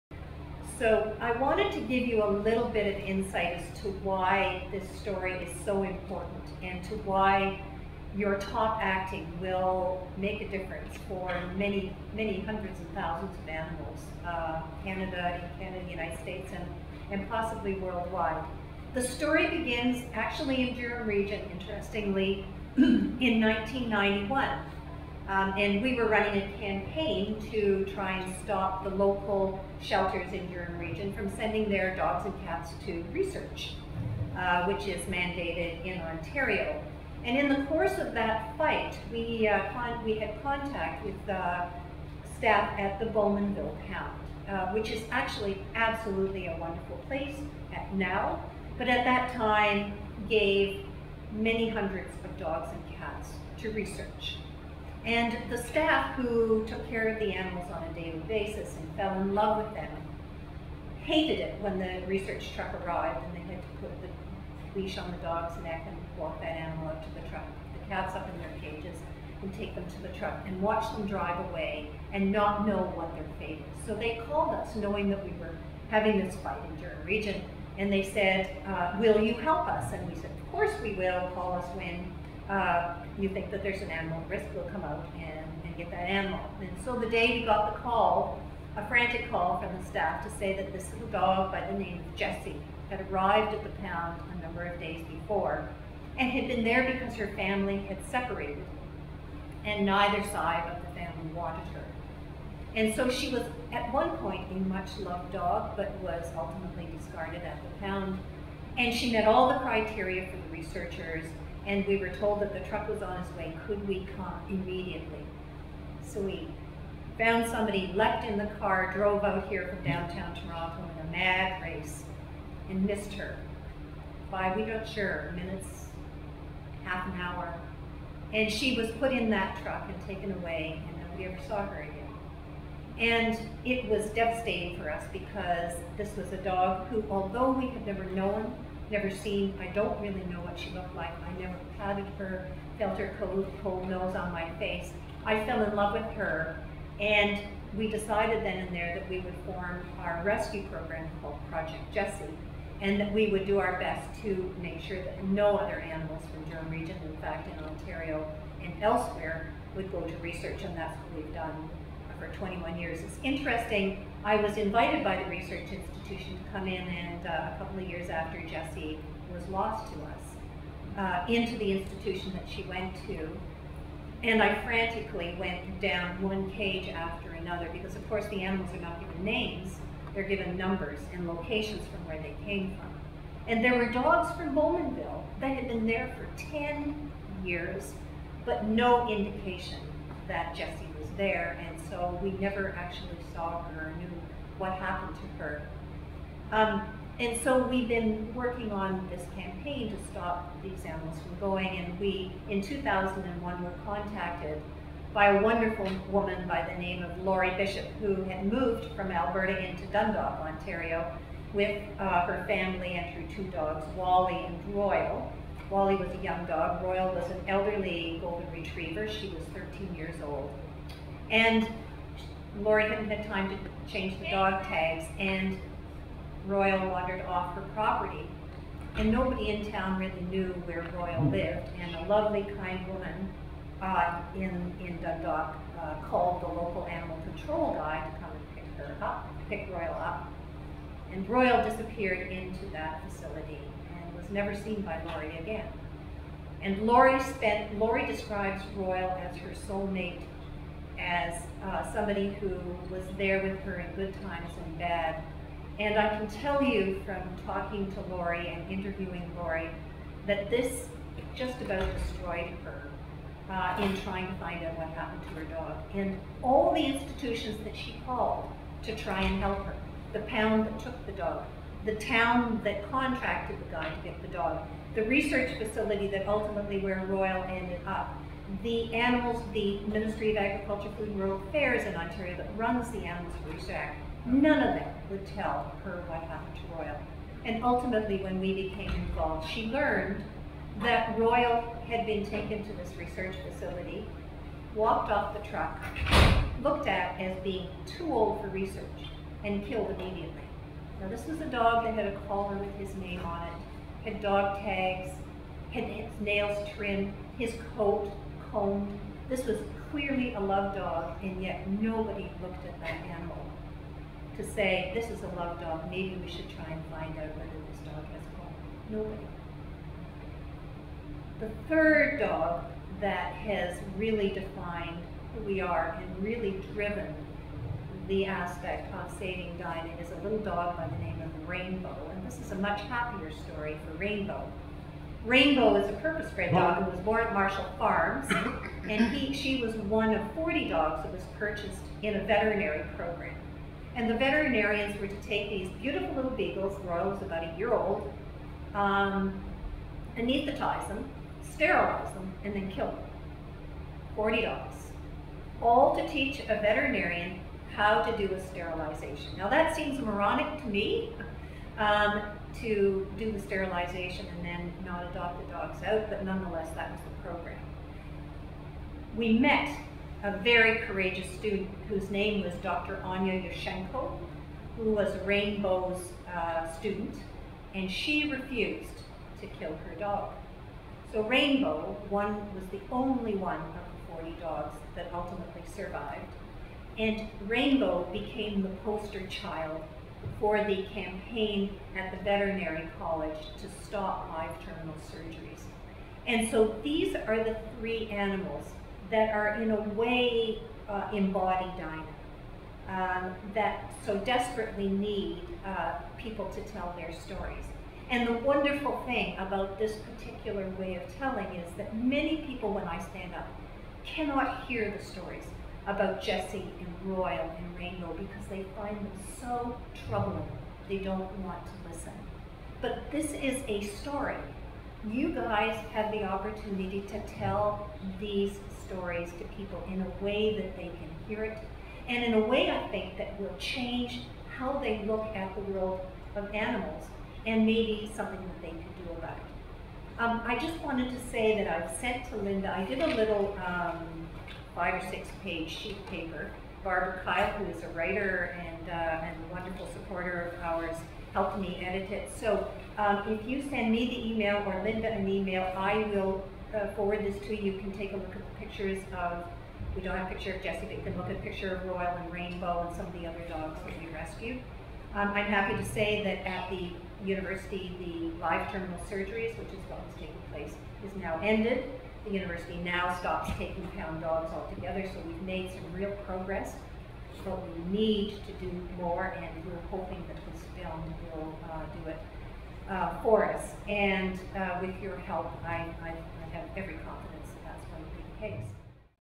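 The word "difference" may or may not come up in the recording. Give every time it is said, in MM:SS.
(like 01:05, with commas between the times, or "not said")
00:10.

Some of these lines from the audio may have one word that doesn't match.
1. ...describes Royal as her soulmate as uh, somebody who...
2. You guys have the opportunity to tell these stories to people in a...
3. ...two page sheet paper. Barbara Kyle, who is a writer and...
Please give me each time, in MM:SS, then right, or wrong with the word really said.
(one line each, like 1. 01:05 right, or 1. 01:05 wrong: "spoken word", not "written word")
1. 04:08 right
2. 07:05 right
3. 07:25 wrong: "six", not "two".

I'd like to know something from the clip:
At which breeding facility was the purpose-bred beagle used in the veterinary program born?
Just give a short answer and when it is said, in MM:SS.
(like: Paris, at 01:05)
Marshall Farms, at 05:37.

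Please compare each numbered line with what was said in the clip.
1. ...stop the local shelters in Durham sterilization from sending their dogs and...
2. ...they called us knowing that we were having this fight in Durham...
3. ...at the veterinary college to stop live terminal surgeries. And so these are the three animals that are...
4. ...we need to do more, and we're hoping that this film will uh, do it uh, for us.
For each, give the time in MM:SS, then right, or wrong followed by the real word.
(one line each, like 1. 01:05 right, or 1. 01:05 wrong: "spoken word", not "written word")
1. 00:28 wrong: "region", not "sterilization"
2. 01:13 right
3. 06:31 right
4. 07:57 right.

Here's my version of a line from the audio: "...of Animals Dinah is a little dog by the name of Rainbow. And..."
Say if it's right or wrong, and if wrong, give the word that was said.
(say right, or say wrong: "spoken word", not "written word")
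wrong: "Saving", not "Animals".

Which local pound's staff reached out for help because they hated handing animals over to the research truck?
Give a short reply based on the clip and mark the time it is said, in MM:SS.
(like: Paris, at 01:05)
Bowmanville Pound, at 00:43.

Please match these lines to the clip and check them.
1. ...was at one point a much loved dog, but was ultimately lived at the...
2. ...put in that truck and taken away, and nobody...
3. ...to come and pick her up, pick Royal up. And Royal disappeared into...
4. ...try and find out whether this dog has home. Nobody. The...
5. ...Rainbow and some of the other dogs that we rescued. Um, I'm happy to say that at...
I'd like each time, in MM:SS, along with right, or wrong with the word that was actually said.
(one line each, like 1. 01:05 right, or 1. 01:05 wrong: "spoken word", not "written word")
1. 01:43 wrong: "discarded", not "lived"
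2. 02:08 right
3. 03:58 right
4. 05:16 right
5. 07:42 right.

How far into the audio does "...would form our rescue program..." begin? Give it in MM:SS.
02:29.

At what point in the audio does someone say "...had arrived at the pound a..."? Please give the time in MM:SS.
01:32.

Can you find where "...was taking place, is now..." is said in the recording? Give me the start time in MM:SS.
07:50.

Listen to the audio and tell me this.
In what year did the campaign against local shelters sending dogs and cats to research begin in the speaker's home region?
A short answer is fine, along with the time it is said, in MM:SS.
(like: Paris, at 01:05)
1991, at 00:23.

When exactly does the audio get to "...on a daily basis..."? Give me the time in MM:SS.
00:57.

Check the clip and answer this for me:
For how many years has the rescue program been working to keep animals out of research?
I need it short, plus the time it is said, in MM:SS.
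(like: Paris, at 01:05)
21, at 02:42.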